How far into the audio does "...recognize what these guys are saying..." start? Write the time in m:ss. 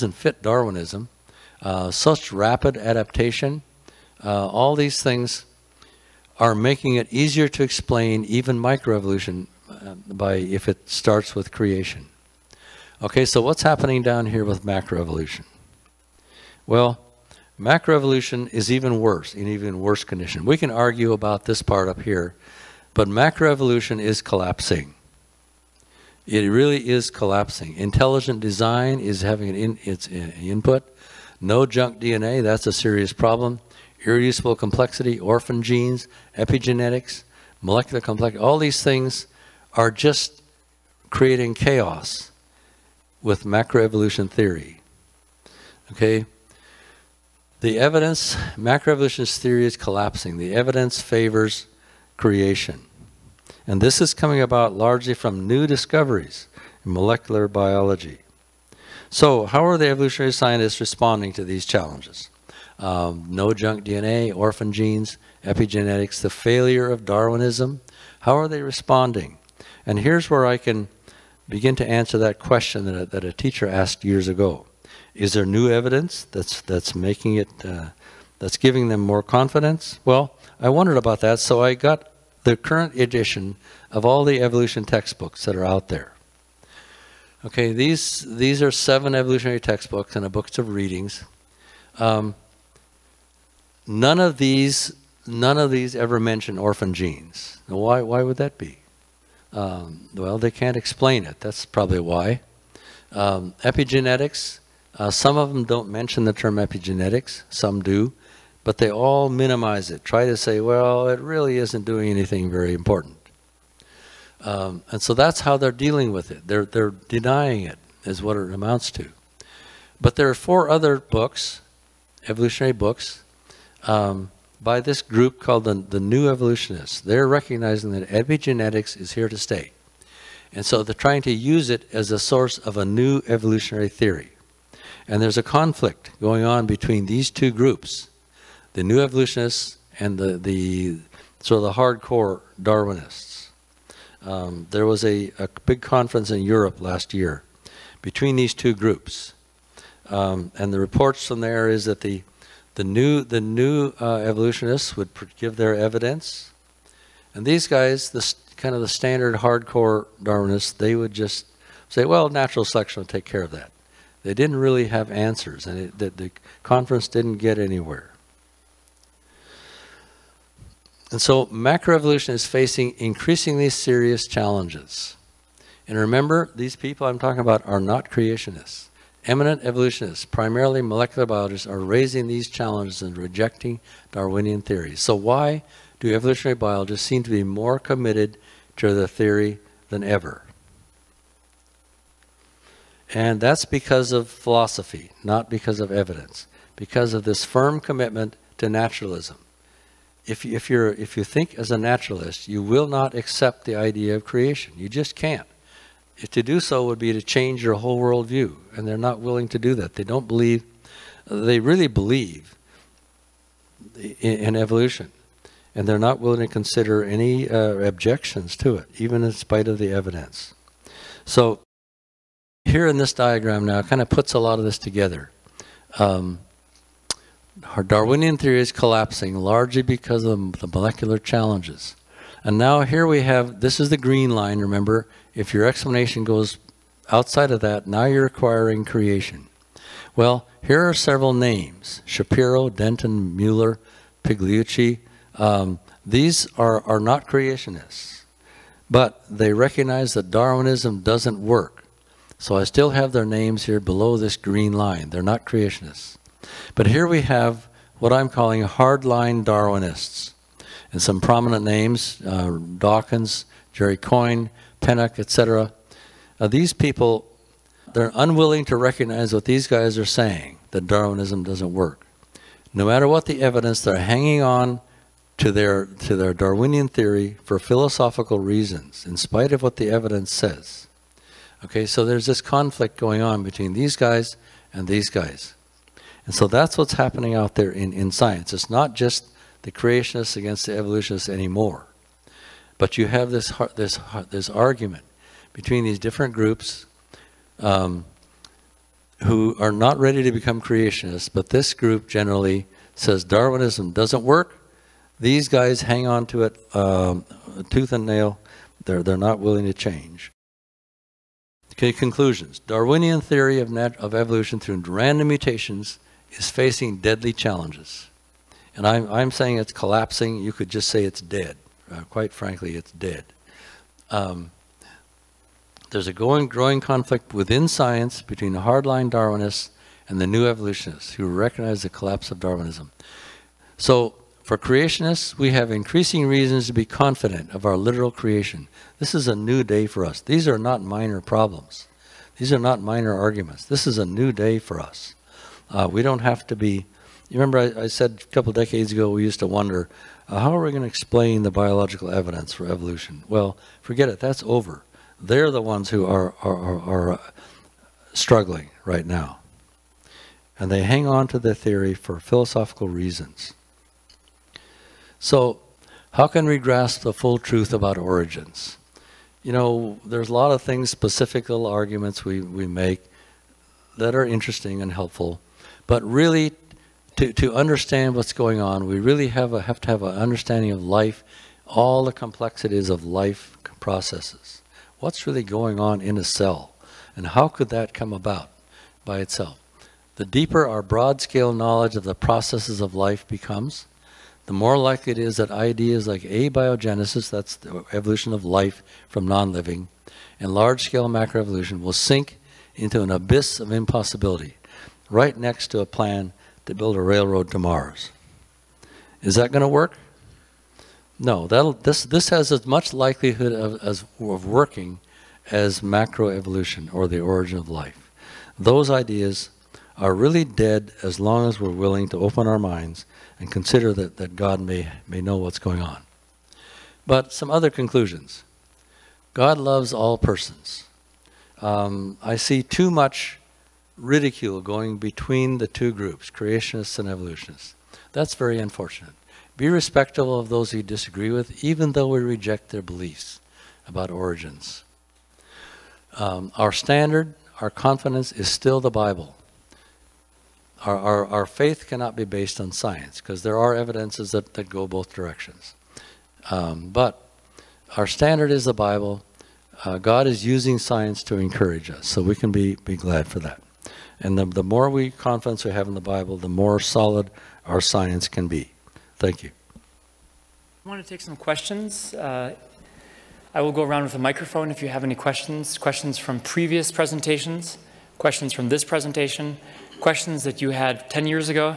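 4:28.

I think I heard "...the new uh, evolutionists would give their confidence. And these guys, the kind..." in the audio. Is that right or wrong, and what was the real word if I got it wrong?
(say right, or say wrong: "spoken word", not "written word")
wrong: "evidence", not "confidence".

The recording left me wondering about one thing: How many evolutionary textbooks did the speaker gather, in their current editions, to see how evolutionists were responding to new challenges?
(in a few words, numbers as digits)
7.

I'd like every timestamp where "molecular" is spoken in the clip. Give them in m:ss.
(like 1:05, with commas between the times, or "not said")
0:37, 0:56, 3:00, 3:50.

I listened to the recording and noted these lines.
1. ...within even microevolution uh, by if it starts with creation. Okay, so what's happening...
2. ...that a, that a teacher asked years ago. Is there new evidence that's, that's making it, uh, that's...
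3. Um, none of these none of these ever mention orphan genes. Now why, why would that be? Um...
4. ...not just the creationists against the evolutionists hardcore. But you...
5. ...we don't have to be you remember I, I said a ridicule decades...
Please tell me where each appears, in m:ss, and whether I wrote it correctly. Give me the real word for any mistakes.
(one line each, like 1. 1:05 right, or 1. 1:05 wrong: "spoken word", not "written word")
1. 0:07 wrong: "explain", not "within"
2. 1:12 right
3. 1:31 right
4. 4:48 wrong: "anymore", not "hardcore"
5. 5:45 wrong: "couple", not "ridicule".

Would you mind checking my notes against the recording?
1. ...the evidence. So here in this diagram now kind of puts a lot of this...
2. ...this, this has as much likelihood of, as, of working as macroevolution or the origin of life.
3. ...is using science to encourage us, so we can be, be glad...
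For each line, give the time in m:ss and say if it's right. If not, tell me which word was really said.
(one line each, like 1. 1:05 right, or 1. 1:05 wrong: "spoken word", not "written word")
1. 3:39 right
2. 6:51 right
3. 7:40 right.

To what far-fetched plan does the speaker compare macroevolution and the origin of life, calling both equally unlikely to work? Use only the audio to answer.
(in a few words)
Railroad to Mars.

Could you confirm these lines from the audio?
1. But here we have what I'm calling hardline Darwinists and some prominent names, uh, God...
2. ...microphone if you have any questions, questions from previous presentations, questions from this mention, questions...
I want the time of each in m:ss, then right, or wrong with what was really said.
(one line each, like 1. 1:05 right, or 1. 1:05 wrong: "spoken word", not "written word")
1. 4:16 wrong: "Dawkins", not "God"
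2. 7:54 wrong: "presentation", not "mention".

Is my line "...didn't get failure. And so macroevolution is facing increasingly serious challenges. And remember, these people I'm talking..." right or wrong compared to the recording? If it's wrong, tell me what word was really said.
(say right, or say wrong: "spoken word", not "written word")
wrong: "anywhere", not "failure".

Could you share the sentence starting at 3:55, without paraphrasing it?
If your explanation goes outside of that, now you're acquiring creation.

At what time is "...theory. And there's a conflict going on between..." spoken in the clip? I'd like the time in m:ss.
2:13.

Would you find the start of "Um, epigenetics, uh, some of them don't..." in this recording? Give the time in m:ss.
1:43.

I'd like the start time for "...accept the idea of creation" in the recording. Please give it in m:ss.
3:23.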